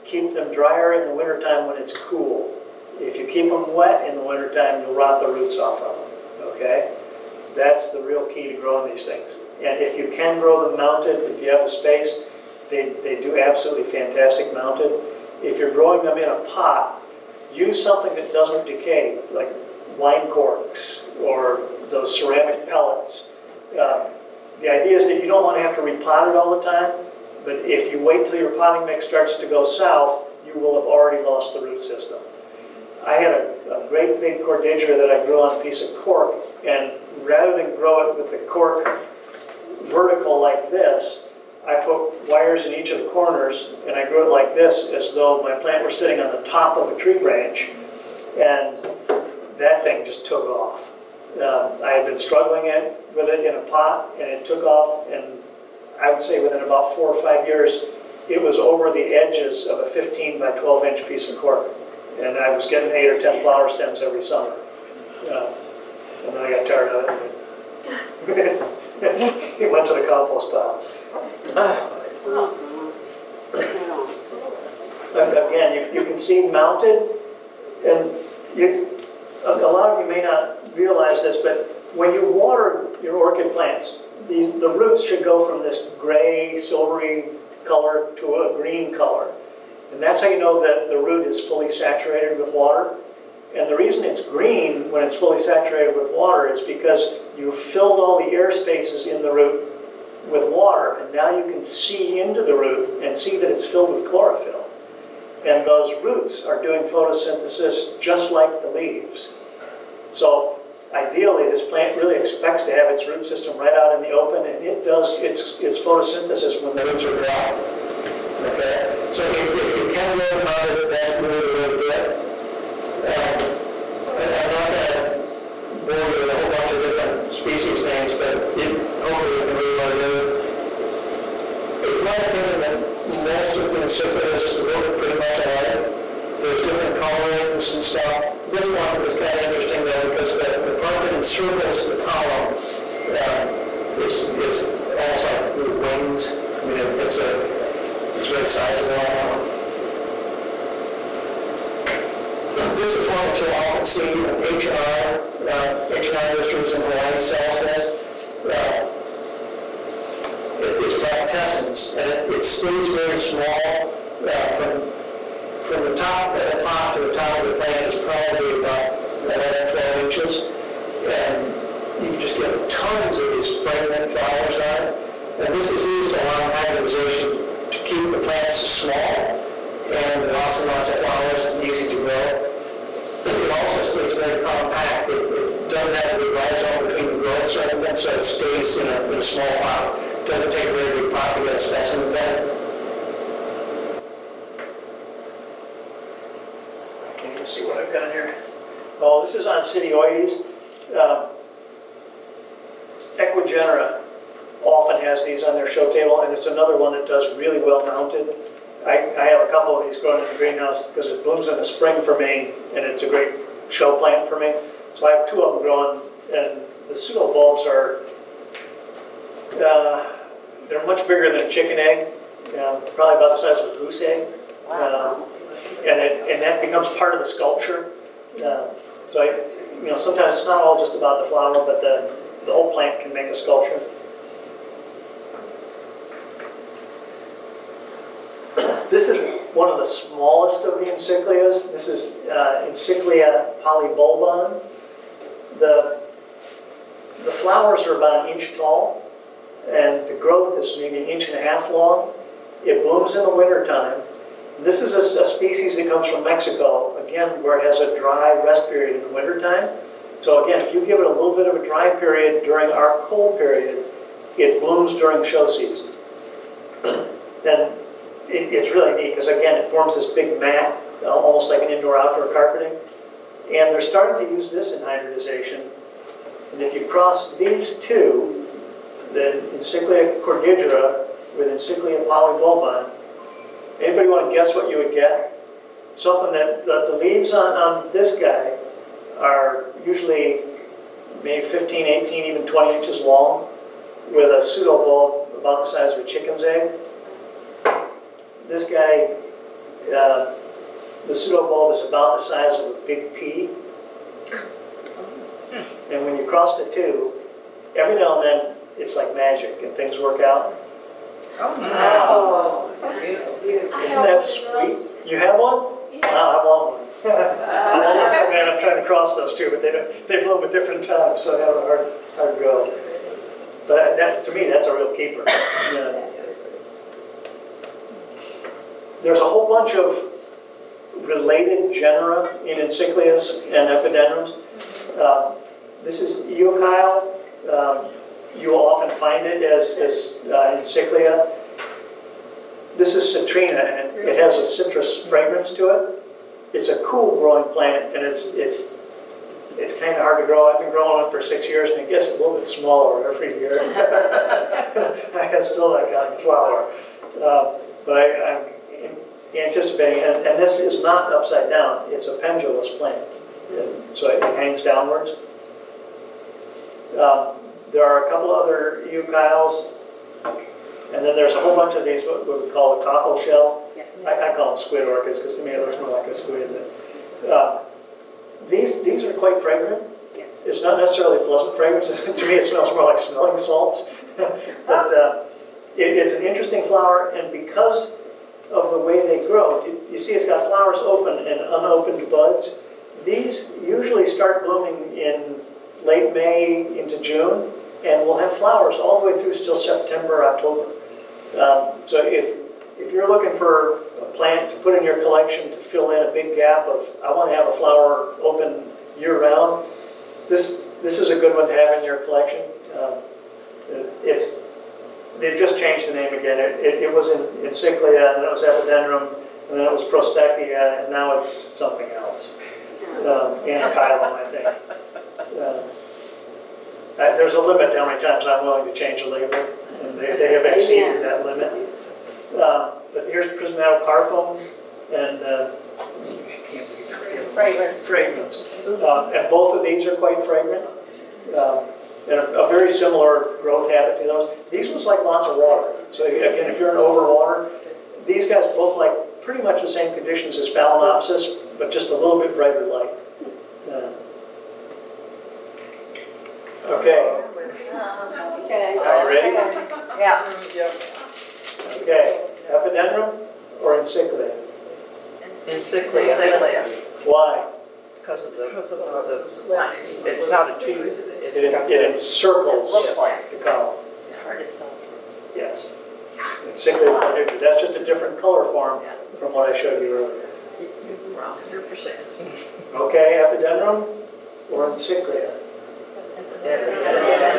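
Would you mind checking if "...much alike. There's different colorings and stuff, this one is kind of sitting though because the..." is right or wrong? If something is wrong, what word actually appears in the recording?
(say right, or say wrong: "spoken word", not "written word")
wrong: "interesting", not "sitting".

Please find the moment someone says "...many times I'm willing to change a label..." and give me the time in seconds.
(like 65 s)
427 s.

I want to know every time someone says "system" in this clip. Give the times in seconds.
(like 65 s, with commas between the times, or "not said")
31 s, 113 s.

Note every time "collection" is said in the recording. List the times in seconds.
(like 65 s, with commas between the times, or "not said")
405 s, 411 s.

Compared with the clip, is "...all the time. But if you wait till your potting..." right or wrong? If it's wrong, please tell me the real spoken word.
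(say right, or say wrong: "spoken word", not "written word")
right.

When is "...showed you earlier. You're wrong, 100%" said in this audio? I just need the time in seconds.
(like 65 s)
479 s.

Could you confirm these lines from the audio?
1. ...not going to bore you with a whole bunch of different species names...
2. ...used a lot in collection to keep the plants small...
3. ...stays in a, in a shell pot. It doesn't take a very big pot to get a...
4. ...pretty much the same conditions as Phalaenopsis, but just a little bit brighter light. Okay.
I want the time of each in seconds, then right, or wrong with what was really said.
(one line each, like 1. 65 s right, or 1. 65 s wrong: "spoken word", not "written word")
1. 124 s right
2. 175 s wrong: "hybridization", not "collection"
3. 188 s wrong: "small", not "shell"
4. 449 s right.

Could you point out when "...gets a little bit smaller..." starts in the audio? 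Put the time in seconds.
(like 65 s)
351 s.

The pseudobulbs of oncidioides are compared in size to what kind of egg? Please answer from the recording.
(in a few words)
goose egg.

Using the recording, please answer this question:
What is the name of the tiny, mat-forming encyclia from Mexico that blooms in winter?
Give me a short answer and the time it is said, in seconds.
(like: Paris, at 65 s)
Encyclia polybulbon, at 242 s.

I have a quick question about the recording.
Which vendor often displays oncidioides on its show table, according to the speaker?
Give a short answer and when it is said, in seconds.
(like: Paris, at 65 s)
Ecuagenera, at 203 s.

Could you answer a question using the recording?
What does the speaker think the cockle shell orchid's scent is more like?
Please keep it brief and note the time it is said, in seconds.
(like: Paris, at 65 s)
smelling salts, at 382 s.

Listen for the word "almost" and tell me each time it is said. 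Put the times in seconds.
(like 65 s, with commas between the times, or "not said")
144 s, 271 s.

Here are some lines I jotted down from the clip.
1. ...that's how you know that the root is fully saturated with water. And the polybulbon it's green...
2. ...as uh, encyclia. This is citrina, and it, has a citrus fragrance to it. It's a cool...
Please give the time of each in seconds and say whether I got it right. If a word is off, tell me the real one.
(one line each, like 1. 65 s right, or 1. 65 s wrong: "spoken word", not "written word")
1. 90 s wrong: "reason", not "polybulbon"
2. 339 s right.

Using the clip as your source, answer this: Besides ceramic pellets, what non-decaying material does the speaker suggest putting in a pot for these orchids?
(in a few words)
wine corks.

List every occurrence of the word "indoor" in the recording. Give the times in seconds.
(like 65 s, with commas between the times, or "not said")
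271 s.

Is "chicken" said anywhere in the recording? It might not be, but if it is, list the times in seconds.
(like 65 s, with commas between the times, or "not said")
221 s, 296 s.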